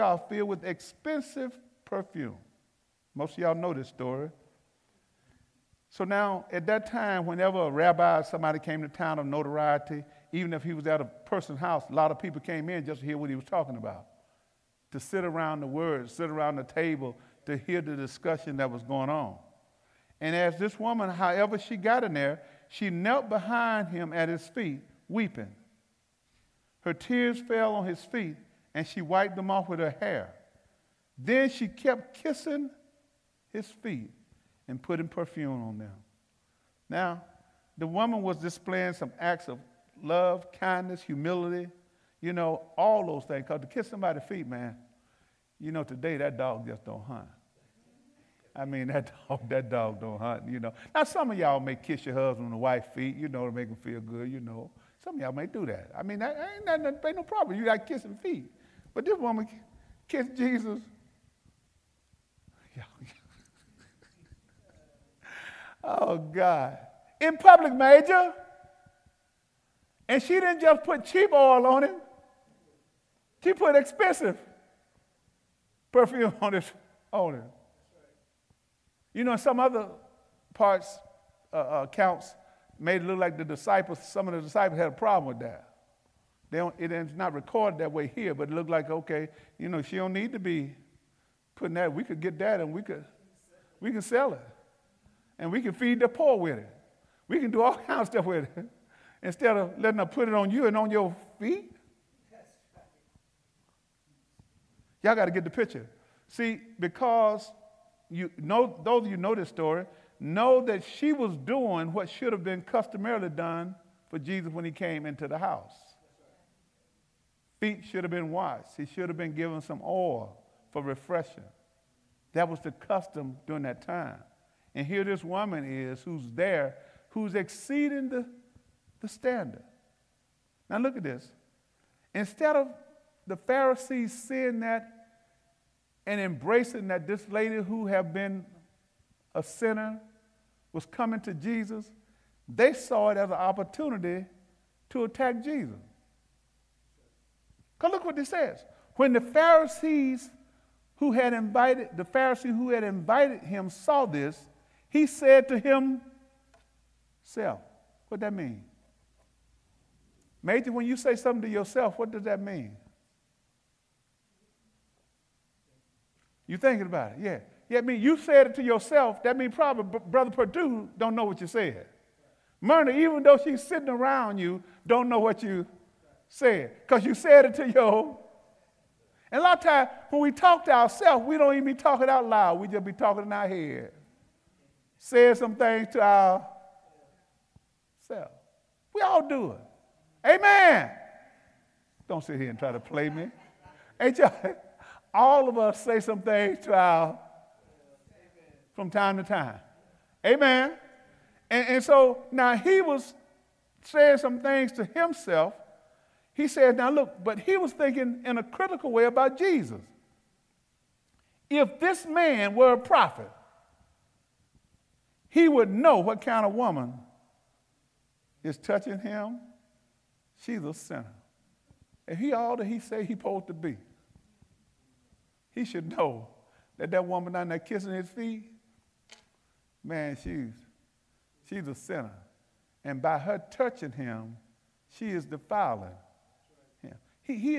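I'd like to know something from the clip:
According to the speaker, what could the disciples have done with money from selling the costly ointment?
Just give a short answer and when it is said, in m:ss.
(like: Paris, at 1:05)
feed the poor, at 1:35.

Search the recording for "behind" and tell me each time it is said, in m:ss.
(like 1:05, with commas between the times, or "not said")
0:23.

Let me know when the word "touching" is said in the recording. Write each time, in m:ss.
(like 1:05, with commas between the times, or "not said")
3:38, 3:53.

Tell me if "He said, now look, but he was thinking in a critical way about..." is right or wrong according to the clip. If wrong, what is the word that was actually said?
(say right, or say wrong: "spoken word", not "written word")
right.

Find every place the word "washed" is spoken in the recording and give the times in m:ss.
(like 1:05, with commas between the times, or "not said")
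1:58.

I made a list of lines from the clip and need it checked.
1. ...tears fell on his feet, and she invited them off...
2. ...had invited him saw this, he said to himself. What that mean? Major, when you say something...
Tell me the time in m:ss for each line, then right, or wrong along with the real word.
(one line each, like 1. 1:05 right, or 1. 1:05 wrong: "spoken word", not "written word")
1. 0:26 wrong: "wiped", not "invited"
2. 2:32 right.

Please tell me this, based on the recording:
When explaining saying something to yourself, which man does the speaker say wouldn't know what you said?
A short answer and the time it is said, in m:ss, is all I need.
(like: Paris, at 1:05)
Brother Purdue, at 2:50.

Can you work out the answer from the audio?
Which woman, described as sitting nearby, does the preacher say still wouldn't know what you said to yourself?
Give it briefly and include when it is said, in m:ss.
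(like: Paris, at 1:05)
Myrna, at 2:52.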